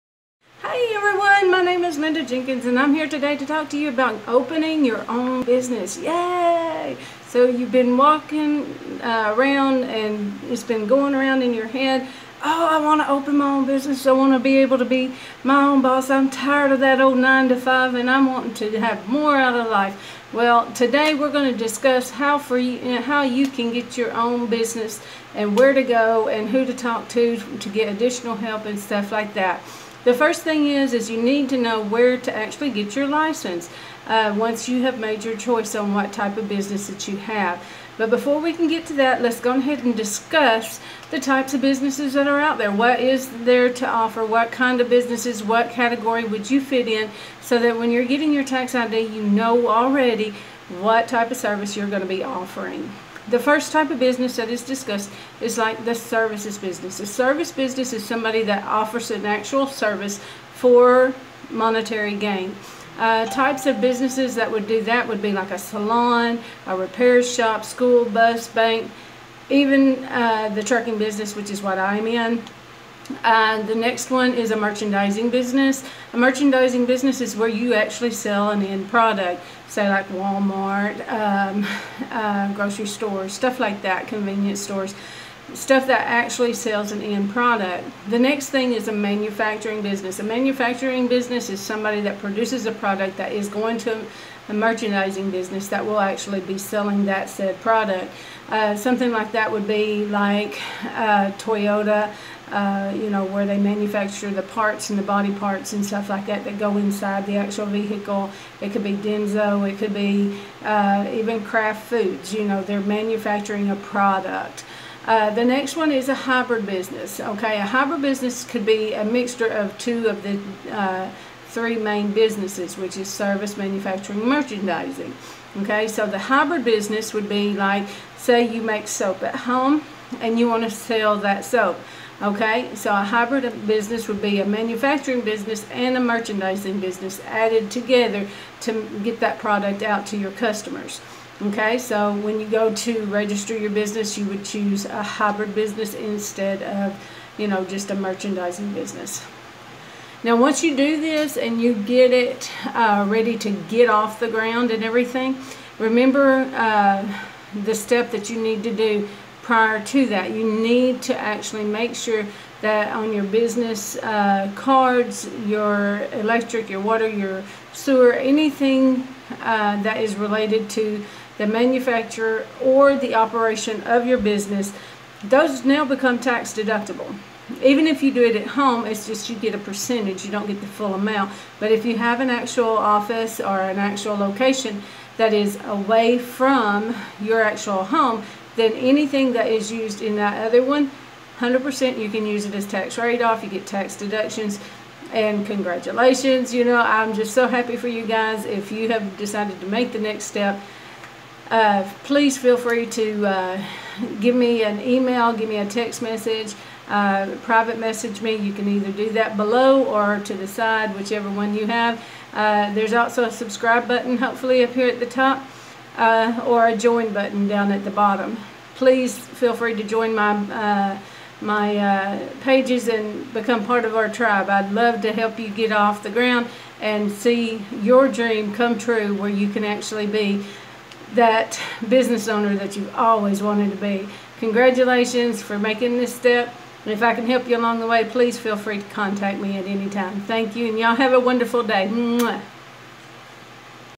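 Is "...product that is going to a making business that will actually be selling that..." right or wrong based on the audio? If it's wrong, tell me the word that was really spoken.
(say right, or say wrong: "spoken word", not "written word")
wrong: "merchandising", not "making".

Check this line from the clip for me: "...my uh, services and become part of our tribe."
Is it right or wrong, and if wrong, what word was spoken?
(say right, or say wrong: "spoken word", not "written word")
wrong: "pages", not "services".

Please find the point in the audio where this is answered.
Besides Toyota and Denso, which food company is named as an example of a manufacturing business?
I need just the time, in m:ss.
1:51.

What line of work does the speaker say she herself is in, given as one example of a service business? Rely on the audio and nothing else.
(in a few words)
Trucking.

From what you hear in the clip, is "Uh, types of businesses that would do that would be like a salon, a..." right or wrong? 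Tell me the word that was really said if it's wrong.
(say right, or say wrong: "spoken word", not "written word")
right.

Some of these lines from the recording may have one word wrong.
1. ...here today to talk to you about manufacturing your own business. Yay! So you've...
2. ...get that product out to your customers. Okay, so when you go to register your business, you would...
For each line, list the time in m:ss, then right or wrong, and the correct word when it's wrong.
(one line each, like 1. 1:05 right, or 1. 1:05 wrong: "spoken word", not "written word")
1. 0:02 wrong: "opening", not "manufacturing"
2. 2:19 right.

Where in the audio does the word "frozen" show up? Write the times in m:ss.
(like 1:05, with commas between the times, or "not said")
not said.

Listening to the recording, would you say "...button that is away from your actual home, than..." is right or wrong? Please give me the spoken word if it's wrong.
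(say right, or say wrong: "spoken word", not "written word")
wrong: "location", not "button".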